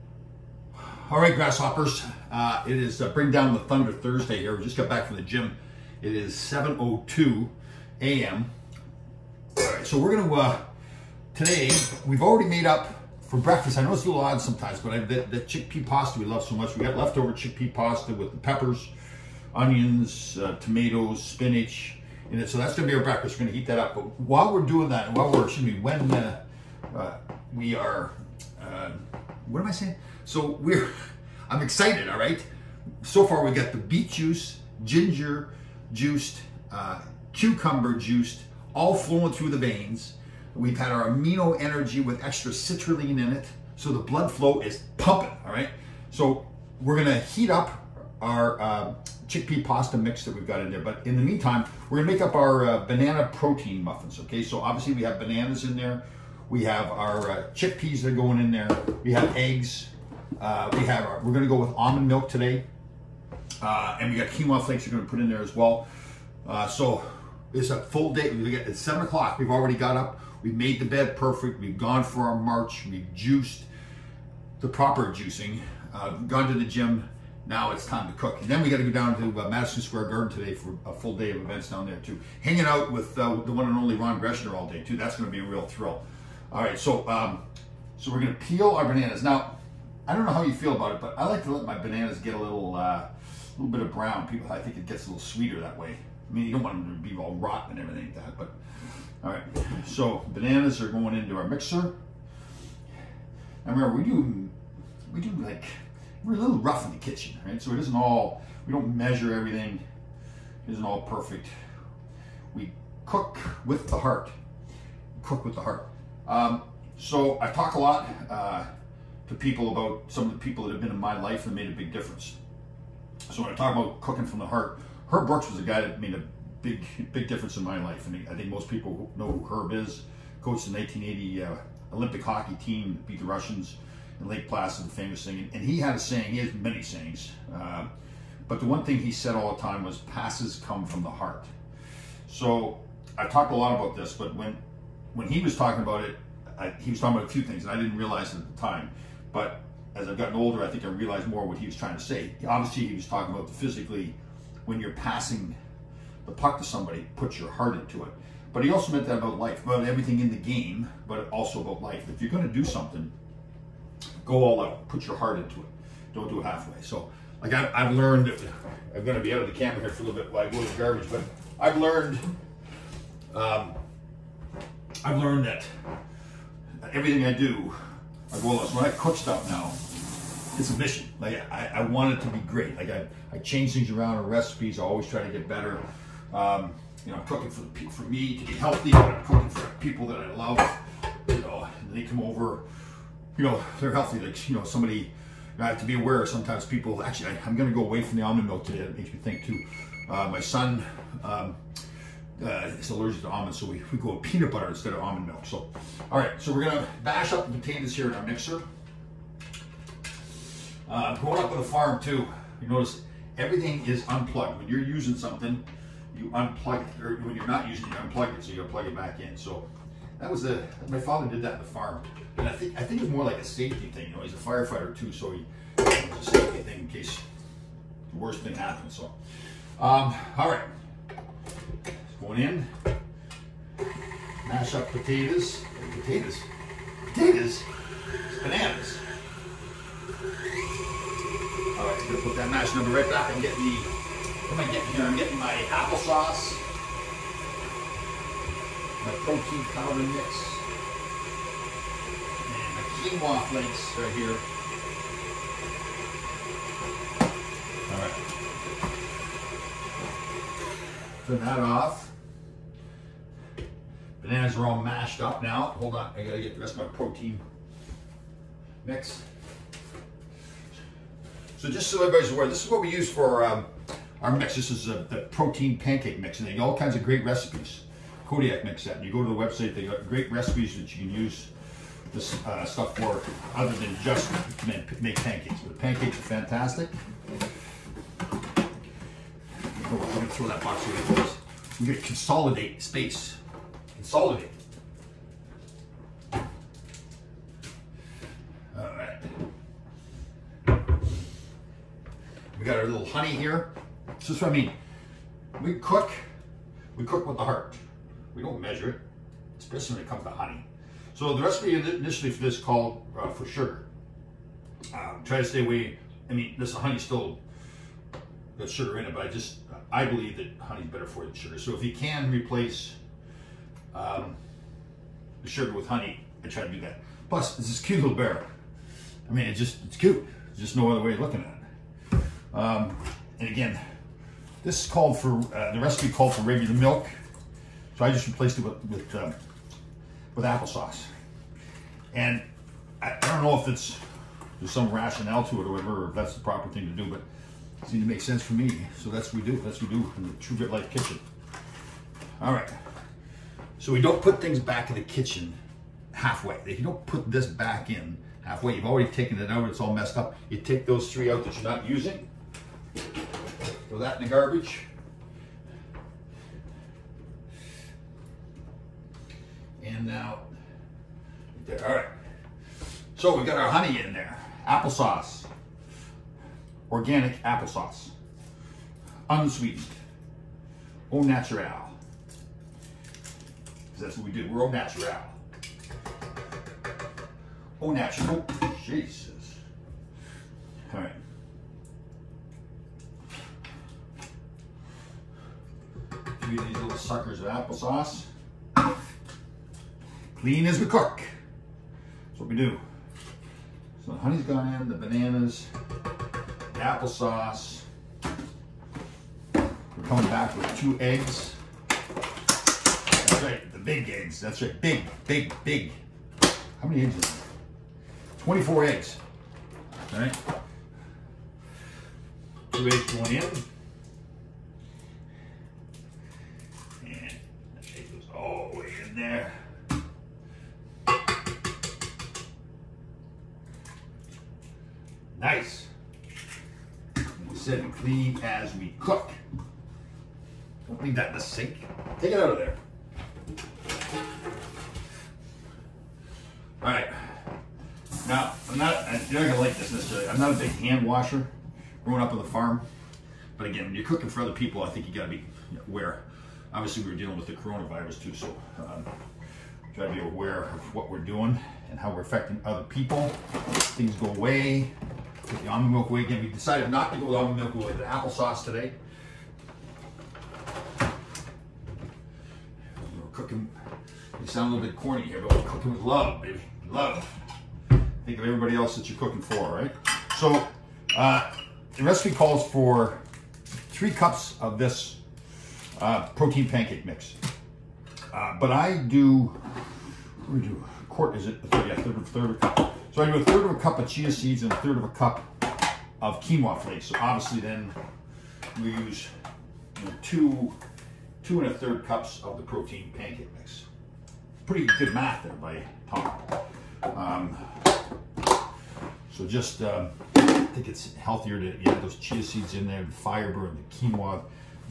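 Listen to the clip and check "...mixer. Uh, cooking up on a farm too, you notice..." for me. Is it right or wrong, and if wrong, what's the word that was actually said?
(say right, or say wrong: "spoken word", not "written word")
wrong: "growing", not "cooking".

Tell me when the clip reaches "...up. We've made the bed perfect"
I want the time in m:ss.
1:09.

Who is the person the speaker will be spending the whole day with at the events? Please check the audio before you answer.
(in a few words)
Ron Greschner.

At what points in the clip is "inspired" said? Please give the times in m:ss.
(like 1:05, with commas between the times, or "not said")
not said.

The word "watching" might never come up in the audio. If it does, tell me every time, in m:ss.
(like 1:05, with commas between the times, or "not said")
not said.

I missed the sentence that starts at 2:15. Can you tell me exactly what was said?
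And he had a saying, he has many sayings.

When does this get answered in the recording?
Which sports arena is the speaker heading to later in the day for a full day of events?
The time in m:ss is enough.
1:19.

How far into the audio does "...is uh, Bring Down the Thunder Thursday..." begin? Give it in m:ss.
0:02.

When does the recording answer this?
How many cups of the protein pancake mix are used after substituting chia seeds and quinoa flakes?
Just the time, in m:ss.
8:21.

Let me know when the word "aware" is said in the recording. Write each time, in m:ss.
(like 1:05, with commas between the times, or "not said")
3:15, 4:32, 7:35, 7:40.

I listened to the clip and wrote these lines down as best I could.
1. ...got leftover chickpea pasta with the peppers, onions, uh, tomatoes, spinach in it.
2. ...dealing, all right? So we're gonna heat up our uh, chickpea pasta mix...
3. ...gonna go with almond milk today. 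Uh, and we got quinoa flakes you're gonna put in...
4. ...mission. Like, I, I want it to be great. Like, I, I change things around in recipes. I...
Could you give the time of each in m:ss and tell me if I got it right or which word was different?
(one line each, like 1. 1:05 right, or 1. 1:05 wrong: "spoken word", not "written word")
1. 0:16 right
2. 0:44 wrong: "pumping", not "dealing"
3. 1:01 right
4. 3:00 right.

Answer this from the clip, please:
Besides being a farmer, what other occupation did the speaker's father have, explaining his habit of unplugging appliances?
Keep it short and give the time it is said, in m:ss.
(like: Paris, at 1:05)
firefighter, at 3:44.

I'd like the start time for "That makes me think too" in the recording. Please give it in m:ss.
3:18.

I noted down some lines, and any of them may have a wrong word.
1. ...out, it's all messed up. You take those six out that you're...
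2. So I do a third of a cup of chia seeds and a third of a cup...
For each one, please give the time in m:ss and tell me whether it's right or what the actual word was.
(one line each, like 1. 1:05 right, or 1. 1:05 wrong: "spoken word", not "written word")
1. 5:59 wrong: "three", not "six"
2. 8:13 right.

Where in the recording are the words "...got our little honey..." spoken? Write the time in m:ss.
5:02.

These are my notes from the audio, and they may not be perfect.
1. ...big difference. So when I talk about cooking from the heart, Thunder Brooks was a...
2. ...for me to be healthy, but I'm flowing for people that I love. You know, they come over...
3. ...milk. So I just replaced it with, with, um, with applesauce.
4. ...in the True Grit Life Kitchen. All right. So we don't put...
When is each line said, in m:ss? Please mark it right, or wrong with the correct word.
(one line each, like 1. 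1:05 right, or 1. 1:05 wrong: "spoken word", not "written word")
1. 2:01 wrong: "Herb", not "Thunder"
2. 3:07 wrong: "cooking", not "flowing"
3. 5:36 right
4. 5:50 right.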